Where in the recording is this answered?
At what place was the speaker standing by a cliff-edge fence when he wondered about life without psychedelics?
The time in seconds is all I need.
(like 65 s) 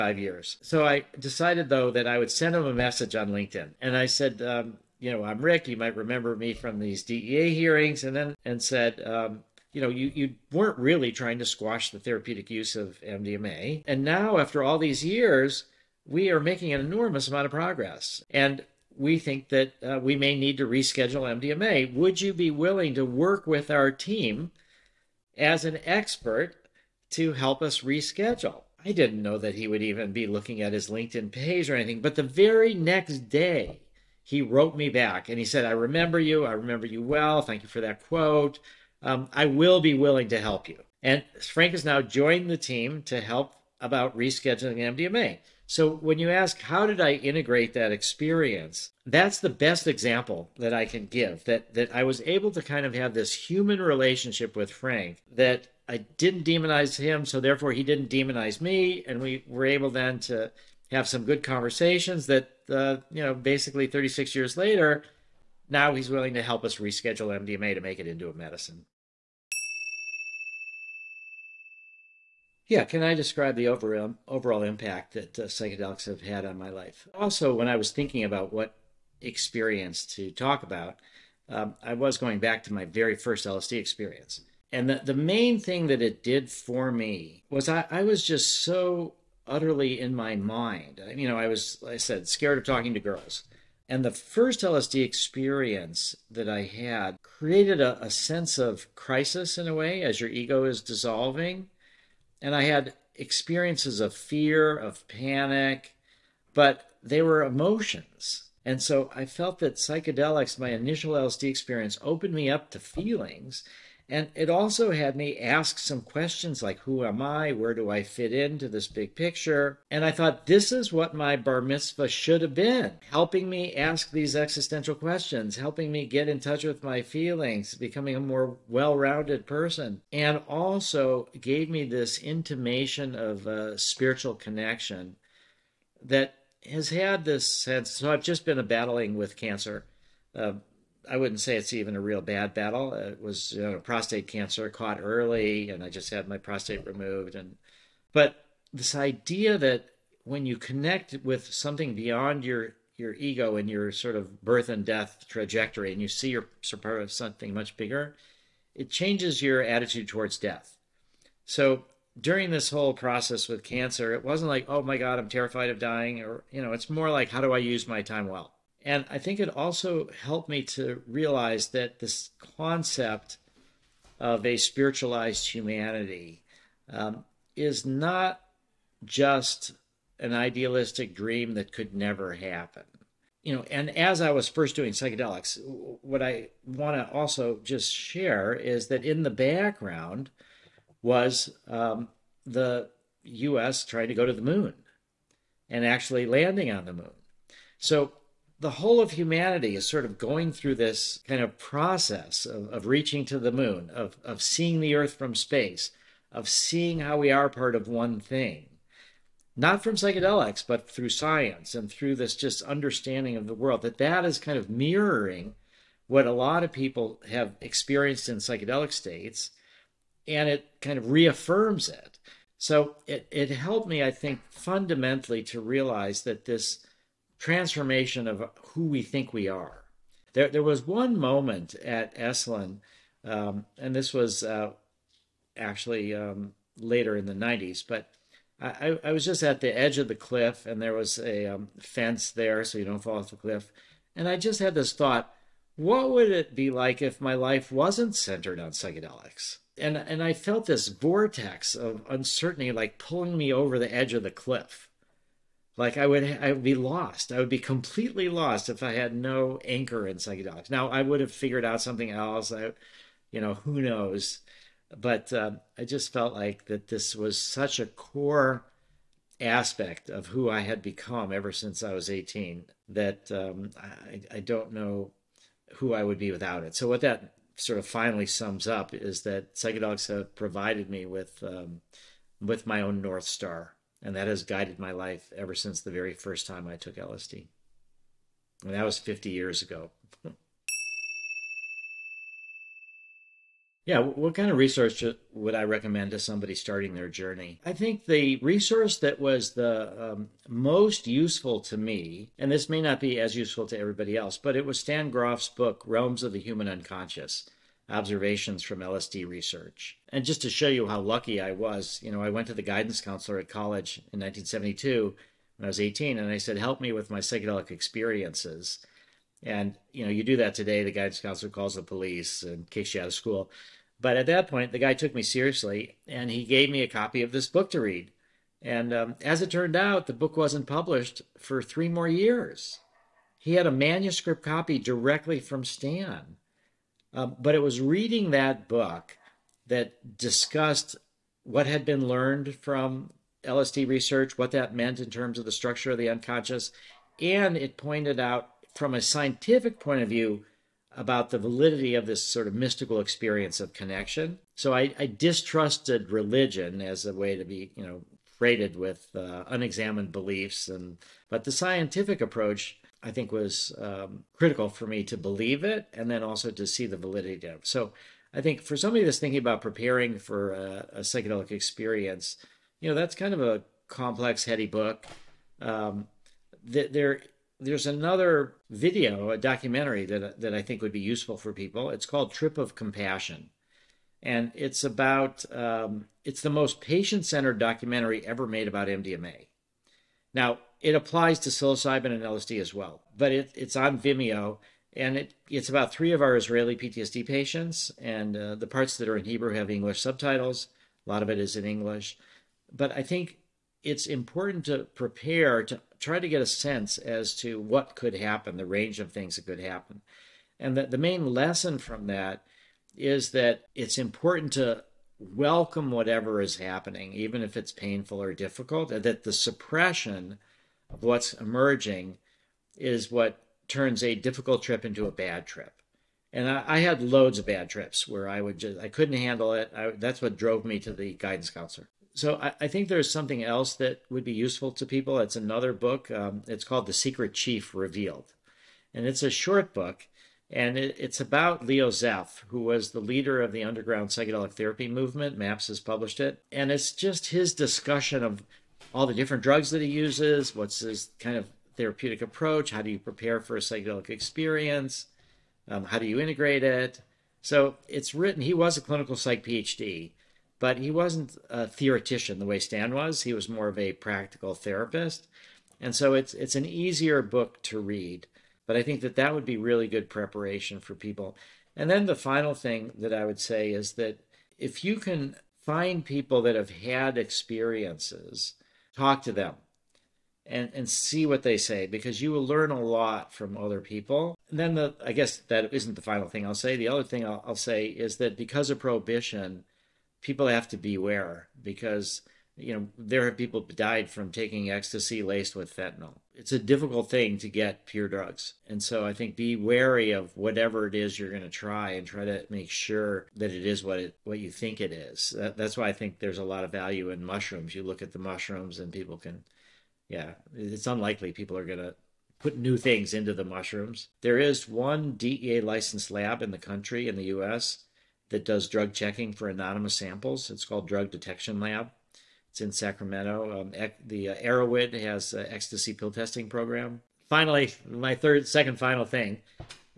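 232 s.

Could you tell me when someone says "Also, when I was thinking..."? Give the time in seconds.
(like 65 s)
77 s.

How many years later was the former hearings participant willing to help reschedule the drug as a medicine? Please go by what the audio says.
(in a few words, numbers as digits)
36.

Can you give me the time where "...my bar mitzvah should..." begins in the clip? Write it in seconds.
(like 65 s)
121 s.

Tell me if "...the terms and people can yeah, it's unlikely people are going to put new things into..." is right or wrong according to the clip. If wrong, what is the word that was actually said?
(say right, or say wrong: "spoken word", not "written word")
wrong: "mushrooms", not "terms".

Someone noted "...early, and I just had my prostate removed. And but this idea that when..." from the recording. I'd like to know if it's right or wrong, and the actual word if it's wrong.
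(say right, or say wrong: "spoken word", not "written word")
right.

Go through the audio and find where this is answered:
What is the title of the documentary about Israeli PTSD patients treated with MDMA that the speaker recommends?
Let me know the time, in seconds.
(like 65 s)
382 s.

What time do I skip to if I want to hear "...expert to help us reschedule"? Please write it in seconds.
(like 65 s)
25 s.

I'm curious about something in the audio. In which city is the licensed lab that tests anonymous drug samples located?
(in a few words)
Sacramento.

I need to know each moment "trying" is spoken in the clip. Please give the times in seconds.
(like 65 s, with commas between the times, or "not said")
11 s, 193 s.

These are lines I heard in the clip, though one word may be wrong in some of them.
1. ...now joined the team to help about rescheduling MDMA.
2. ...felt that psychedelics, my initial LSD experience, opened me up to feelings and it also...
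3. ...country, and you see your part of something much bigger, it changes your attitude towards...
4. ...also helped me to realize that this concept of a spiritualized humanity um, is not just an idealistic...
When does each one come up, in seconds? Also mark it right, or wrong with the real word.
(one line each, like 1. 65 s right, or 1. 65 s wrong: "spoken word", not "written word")
1. 41 s right
2. 109 s right
3. 155 s wrong: "trajectory", not "country"
4. 169 s right.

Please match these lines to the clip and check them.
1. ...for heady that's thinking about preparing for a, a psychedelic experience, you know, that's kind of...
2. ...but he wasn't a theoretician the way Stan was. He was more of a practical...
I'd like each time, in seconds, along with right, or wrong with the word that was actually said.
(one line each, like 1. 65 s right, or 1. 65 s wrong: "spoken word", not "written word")
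1. 368 s wrong: "somebody", not "heady"
2. 460 s right.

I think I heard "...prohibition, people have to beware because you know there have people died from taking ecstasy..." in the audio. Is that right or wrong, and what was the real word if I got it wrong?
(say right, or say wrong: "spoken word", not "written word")
right.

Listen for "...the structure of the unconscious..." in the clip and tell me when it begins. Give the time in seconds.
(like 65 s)
345 s.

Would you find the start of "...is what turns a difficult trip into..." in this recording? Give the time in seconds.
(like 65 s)
422 s.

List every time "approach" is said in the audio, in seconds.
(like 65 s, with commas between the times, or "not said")
362 s, 452 s.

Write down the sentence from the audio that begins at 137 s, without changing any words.
So I've just been battling with cancer.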